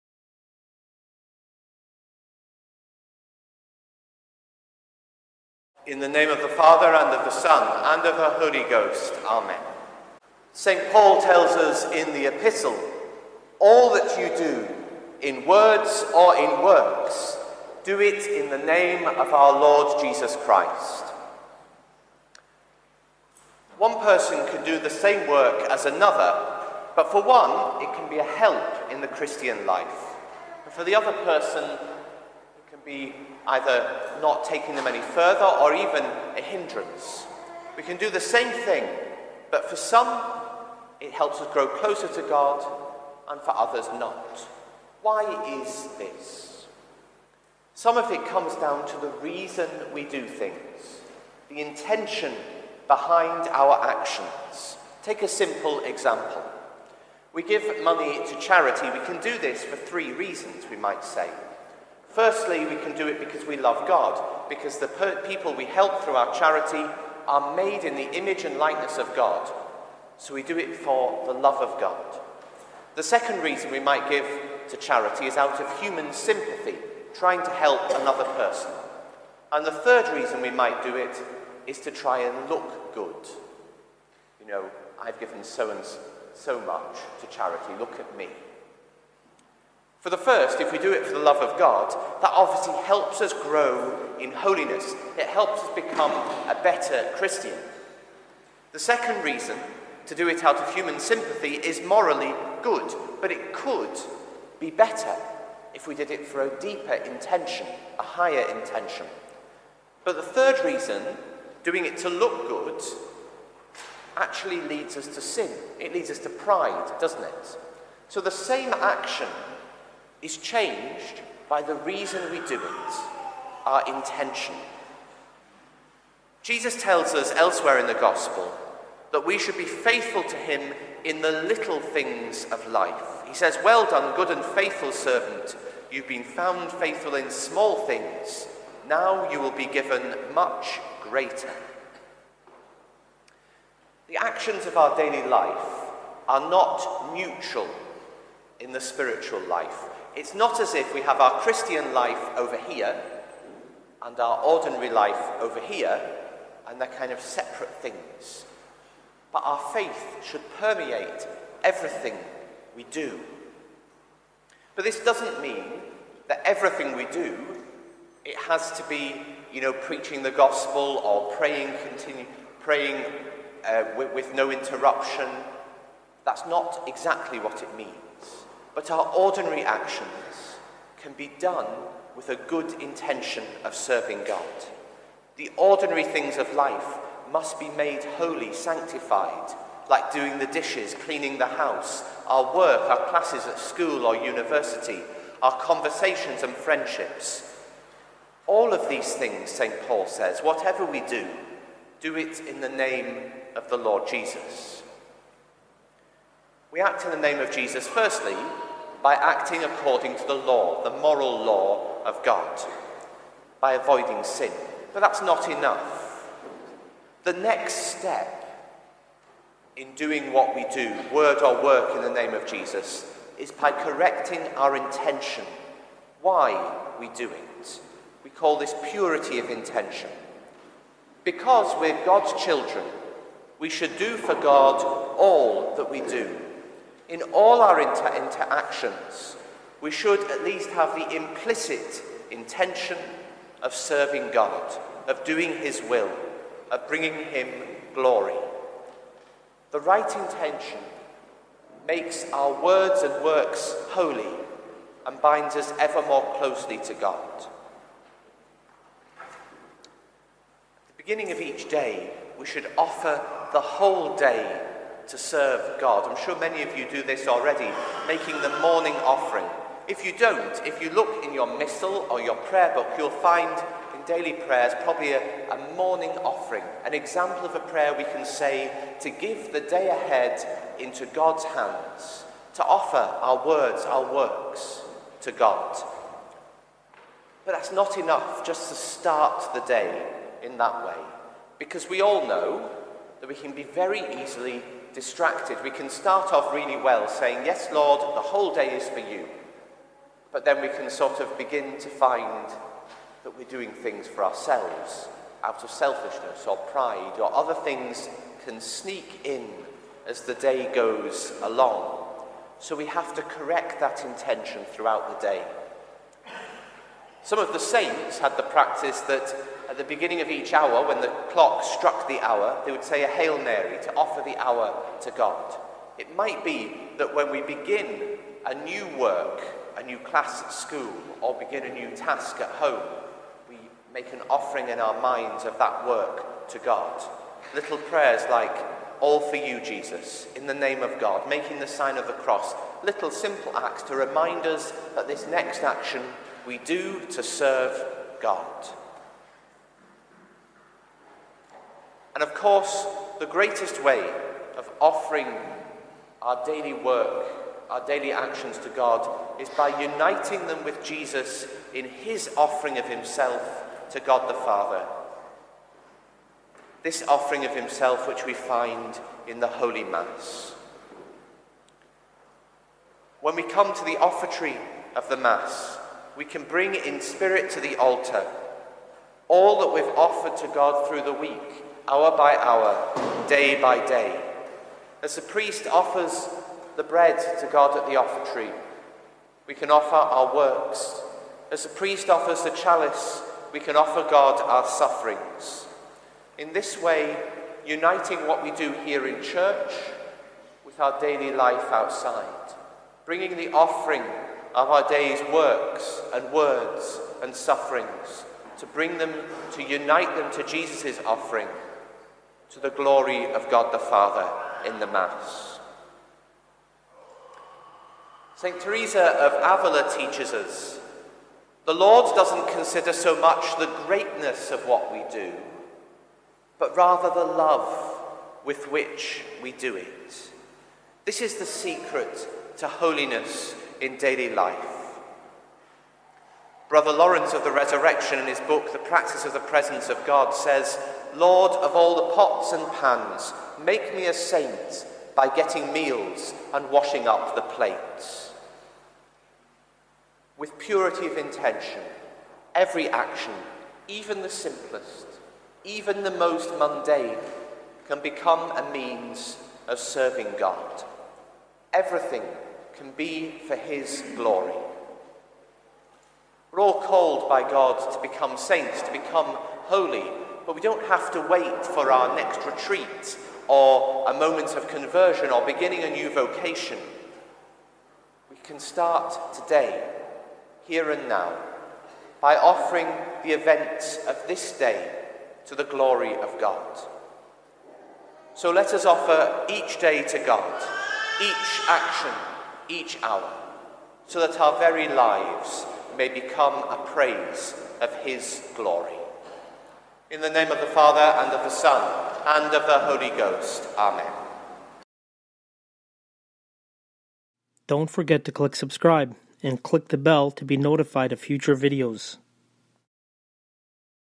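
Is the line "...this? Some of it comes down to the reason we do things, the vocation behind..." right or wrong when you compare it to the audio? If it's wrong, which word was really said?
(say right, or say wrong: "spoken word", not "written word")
wrong: "intention", not "vocation".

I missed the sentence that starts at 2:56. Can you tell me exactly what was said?
That's not exactly what it means but our ordinary actions can be done with a good intention of serving God.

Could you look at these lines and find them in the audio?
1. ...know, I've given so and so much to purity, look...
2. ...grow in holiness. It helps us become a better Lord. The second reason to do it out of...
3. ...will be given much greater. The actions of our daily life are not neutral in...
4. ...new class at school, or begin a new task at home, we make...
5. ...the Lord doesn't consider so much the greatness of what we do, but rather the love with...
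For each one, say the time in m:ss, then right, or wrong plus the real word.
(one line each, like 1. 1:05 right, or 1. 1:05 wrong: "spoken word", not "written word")
1. 1:24 wrong: "charity", not "purity"
2. 1:33 wrong: "Christian", not "Lord"
3. 2:19 right
4. 5:29 right
5. 7:01 right.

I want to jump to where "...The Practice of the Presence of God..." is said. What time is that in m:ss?
7:18.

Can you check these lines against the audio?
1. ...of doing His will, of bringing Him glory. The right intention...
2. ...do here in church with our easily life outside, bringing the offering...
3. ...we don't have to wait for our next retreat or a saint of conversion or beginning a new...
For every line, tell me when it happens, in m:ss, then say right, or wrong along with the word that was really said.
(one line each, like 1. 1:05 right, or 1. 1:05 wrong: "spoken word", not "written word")
1. 4:05 right
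2. 6:38 wrong: "daily", not "easily"
3. 7:50 wrong: "moment", not "saint".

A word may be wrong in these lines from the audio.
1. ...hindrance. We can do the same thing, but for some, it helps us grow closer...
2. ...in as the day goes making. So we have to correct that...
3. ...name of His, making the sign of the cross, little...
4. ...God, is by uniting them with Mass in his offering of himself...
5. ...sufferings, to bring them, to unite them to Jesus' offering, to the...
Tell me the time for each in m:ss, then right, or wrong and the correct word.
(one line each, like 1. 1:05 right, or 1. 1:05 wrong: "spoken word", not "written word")
1. 0:36 right
2. 5:09 wrong: "along", not "making"
3. 5:40 wrong: "God", not "His"
4. 5:58 wrong: "Jesus", not "Mass"
5. 6:47 right.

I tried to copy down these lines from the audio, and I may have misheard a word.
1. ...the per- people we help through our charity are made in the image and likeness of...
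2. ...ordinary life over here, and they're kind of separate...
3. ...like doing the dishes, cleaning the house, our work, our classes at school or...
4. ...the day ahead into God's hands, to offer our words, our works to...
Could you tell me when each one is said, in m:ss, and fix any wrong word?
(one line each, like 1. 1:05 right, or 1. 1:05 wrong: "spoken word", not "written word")
1. 1:04 right
2. 2:34 right
3. 3:09 right
4. 4:39 right.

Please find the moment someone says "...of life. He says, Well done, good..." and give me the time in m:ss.
2:12.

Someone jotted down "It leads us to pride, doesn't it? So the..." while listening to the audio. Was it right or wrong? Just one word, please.
right.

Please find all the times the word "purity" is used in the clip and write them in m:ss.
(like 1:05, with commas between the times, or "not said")
3:48, 7:30.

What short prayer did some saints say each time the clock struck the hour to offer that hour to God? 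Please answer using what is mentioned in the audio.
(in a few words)
Hail Mary.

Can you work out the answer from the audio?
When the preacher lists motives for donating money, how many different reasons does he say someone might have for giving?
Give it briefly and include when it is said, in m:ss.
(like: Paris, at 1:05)
3, at 0:59.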